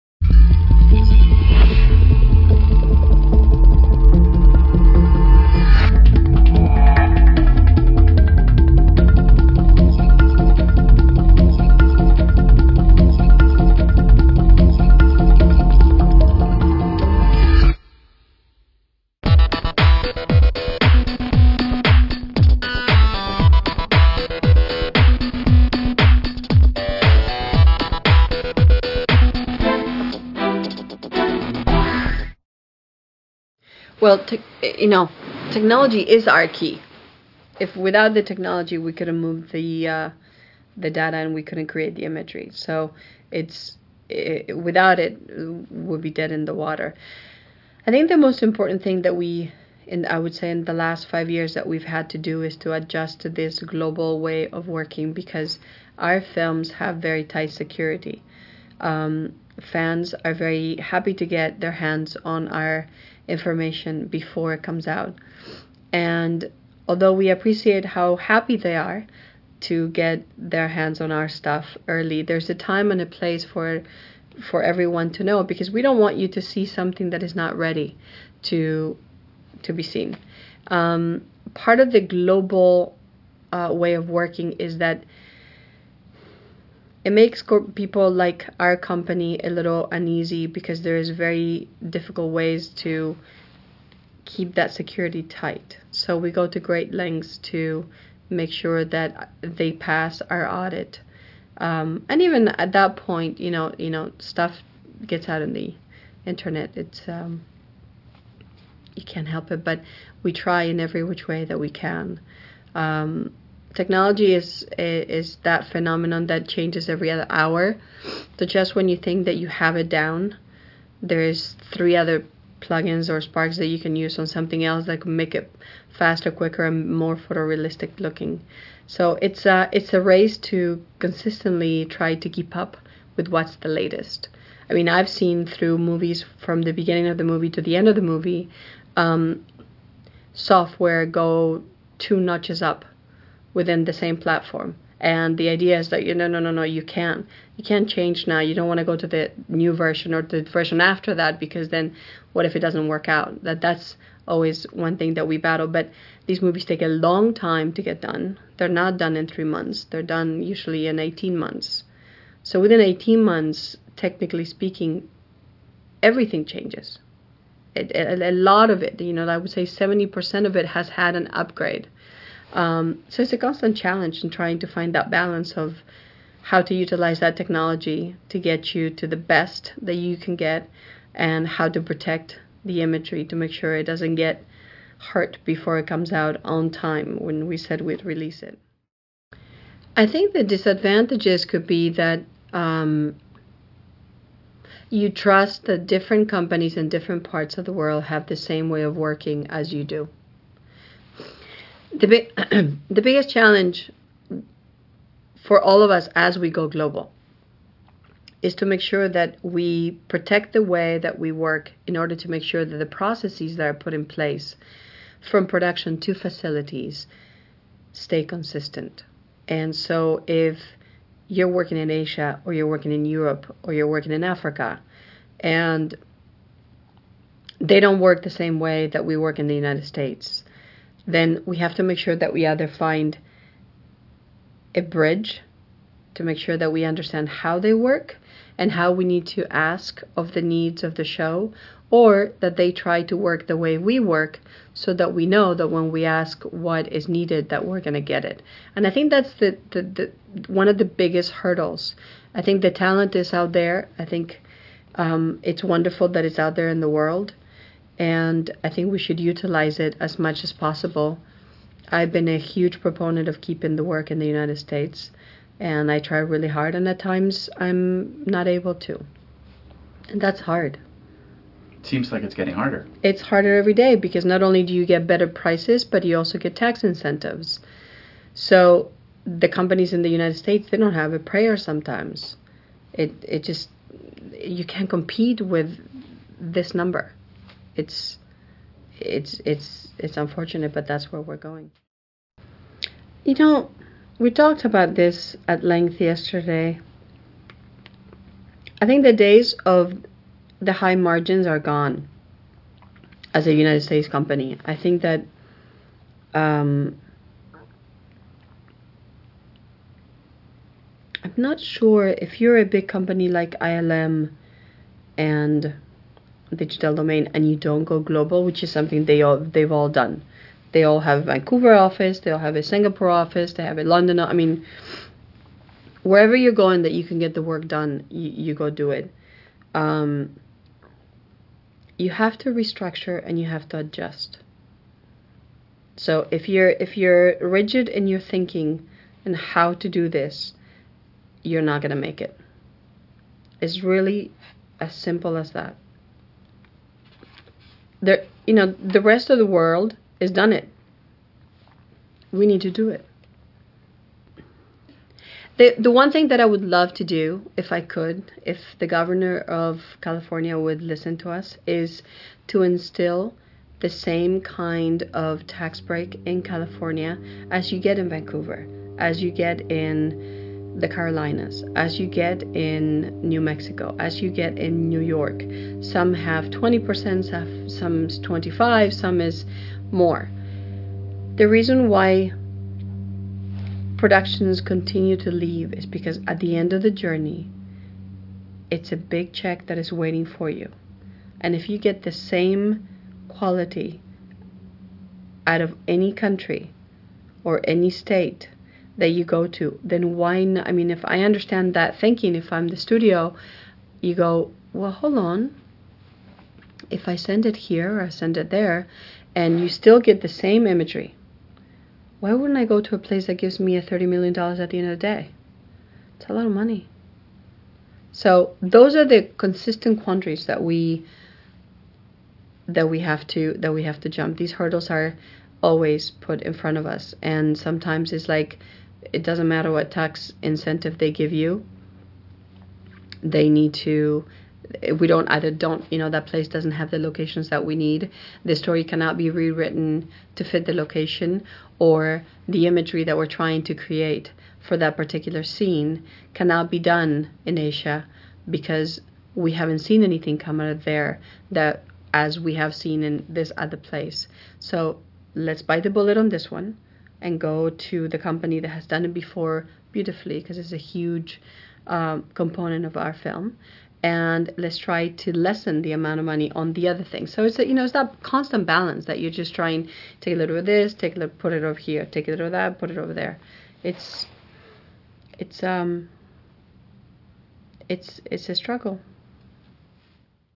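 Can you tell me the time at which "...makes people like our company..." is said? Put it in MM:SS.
01:27.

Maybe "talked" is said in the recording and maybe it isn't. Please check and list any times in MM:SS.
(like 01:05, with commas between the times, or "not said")
04:54.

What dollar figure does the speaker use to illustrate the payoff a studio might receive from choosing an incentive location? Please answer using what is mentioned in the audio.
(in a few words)
$30 million.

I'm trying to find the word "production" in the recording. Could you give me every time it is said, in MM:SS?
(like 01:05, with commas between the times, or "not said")
03:35, 06:23.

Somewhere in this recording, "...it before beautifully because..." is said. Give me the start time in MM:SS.
07:39.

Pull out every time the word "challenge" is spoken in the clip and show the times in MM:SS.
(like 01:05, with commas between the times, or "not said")
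02:53, 03:23.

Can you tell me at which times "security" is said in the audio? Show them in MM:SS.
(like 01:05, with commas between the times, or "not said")
00:57, 01:34.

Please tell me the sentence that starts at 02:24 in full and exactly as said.
And the idea is that you no no no no you can't you can't change now.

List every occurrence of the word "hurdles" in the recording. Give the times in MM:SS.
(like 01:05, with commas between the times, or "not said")
04:11, 07:04.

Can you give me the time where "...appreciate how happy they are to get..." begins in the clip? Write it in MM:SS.
01:07.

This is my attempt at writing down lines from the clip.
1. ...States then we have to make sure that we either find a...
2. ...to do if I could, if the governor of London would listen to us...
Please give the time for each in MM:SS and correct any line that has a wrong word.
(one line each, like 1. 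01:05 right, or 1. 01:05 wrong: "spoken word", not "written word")
1. 03:49 right
2. 05:56 wrong: "California", not "London".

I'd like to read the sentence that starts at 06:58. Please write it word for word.
So those are the consistent quandaries that we that we have to that we have to jump.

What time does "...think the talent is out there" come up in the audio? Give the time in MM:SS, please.
04:12.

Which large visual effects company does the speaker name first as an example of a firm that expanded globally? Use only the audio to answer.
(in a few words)
ILM.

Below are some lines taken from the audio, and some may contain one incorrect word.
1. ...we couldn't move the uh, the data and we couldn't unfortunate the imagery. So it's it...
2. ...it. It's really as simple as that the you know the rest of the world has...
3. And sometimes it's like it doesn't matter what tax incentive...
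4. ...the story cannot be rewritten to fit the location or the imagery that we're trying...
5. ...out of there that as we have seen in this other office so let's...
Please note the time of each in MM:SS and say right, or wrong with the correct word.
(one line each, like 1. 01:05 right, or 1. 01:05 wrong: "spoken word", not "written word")
1. 00:38 wrong: "create", not "unfortunate"
2. 05:42 right
3. 07:07 right
4. 07:18 right
5. 07:30 wrong: "place", not "office".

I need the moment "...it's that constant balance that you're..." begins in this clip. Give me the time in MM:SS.
07:47.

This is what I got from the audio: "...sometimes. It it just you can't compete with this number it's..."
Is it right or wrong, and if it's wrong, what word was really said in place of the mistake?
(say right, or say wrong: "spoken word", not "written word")
right.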